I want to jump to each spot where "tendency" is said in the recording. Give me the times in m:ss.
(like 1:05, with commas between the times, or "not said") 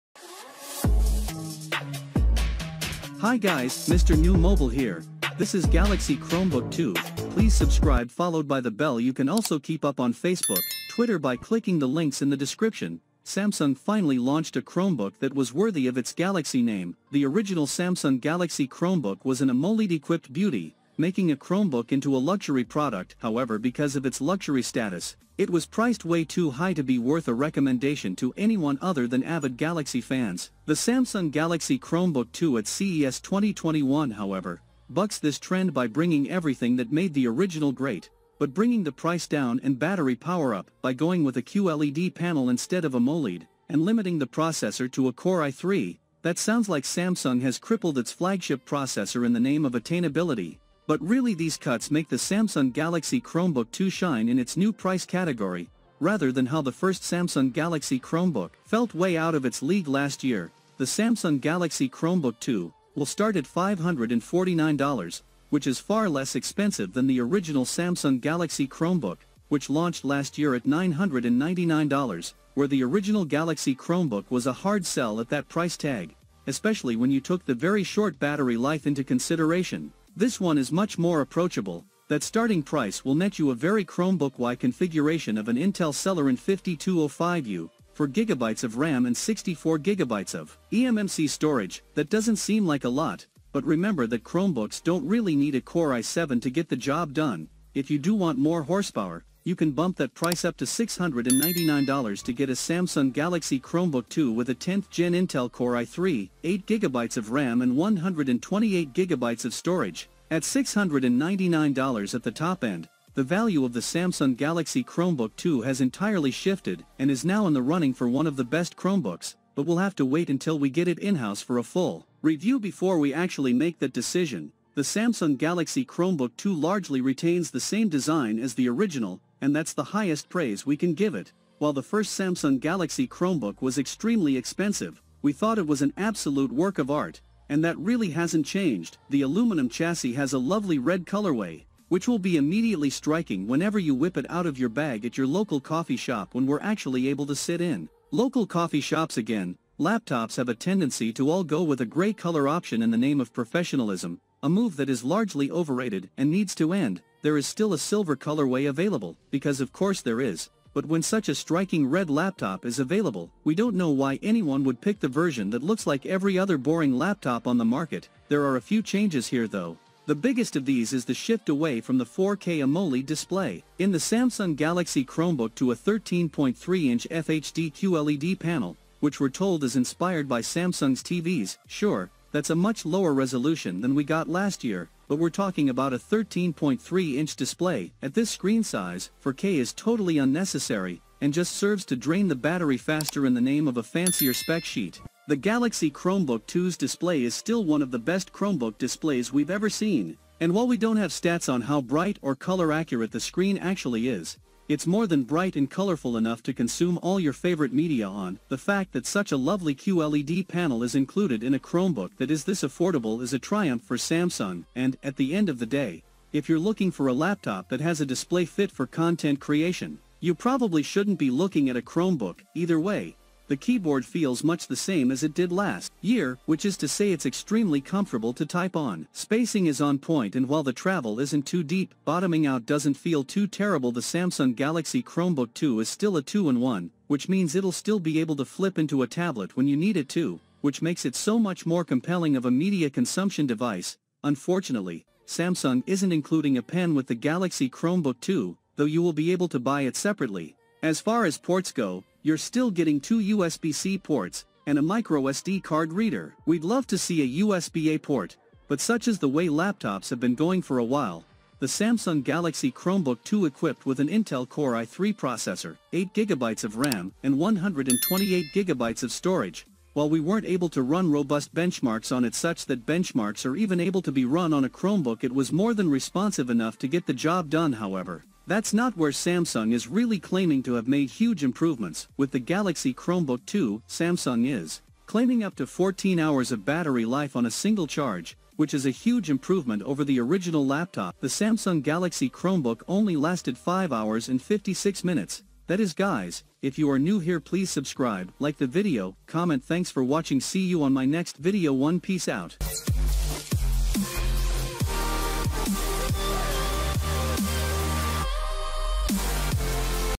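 2:30.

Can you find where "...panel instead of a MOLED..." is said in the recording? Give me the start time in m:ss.
0:42.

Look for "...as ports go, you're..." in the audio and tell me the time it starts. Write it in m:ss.
4:11.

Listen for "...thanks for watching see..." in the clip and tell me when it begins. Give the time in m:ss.
4:59.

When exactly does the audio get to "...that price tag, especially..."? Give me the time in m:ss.
1:15.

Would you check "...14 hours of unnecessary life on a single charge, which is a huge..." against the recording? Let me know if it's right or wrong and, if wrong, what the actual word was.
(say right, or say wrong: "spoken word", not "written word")
wrong: "battery", not "unnecessary".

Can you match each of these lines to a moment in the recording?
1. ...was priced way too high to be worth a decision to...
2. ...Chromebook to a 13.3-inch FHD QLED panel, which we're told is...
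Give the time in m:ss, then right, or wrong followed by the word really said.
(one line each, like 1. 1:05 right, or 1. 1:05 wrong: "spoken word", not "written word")
1. 0:25 wrong: "recommendation", not "decision"
2. 2:55 right.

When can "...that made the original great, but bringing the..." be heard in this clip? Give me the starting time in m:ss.
0:36.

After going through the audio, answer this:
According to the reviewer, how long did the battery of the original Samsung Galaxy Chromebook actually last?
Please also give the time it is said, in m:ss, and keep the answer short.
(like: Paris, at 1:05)
5 hours 56 minutes, at 4:53.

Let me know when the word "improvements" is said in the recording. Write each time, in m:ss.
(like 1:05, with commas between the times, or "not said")
4:41, 4:49.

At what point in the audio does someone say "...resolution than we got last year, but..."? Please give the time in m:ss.
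3:03.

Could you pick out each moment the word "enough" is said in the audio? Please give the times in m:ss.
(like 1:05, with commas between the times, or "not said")
3:26, 4:36.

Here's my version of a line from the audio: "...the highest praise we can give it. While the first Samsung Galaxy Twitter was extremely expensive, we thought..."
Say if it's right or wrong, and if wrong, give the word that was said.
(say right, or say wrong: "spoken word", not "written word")
wrong: "Chromebook", not "Twitter".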